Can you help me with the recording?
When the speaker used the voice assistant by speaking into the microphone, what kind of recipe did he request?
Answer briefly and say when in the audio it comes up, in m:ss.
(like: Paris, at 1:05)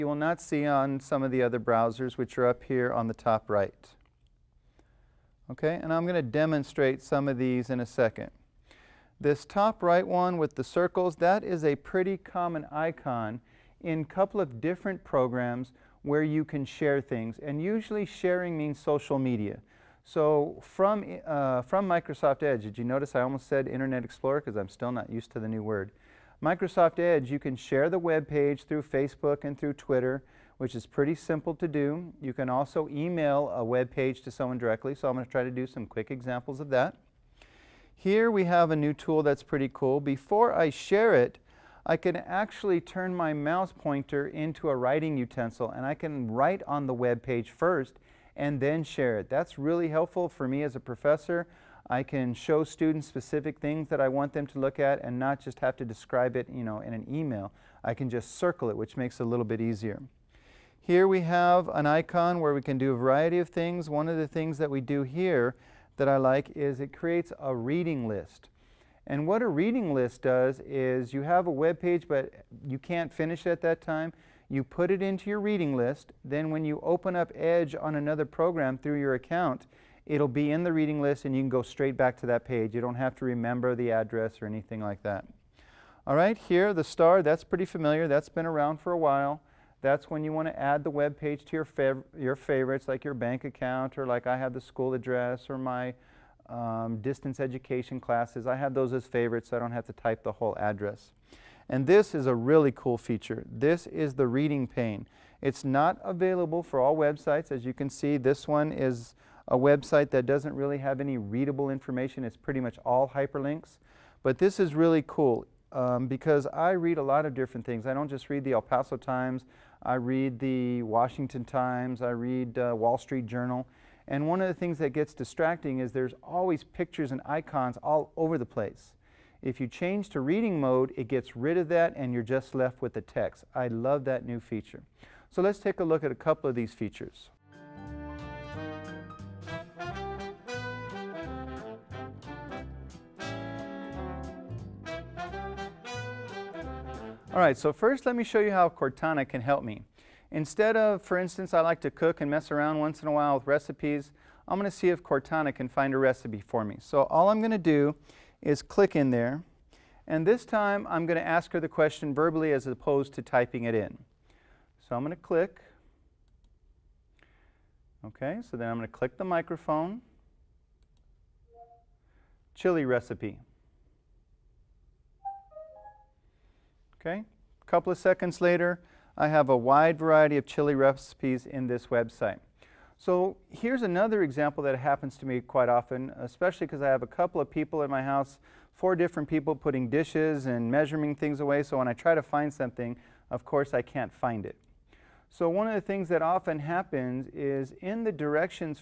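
Chili recipe, at 2:52.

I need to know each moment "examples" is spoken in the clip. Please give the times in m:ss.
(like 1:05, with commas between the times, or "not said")
0:36, 3:04.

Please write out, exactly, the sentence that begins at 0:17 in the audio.
And usually sharing means social media.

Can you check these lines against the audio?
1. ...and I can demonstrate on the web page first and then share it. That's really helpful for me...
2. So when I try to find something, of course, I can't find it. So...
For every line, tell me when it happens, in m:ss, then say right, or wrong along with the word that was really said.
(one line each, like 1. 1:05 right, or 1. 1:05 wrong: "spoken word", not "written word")
1. 0:45 wrong: "write", not "demonstrate"
2. 3:11 right.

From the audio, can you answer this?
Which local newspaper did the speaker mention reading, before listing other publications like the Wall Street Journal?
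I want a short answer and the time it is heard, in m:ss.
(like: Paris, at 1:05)
El Paso Times, at 1:58.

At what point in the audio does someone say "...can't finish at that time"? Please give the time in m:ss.
1:12.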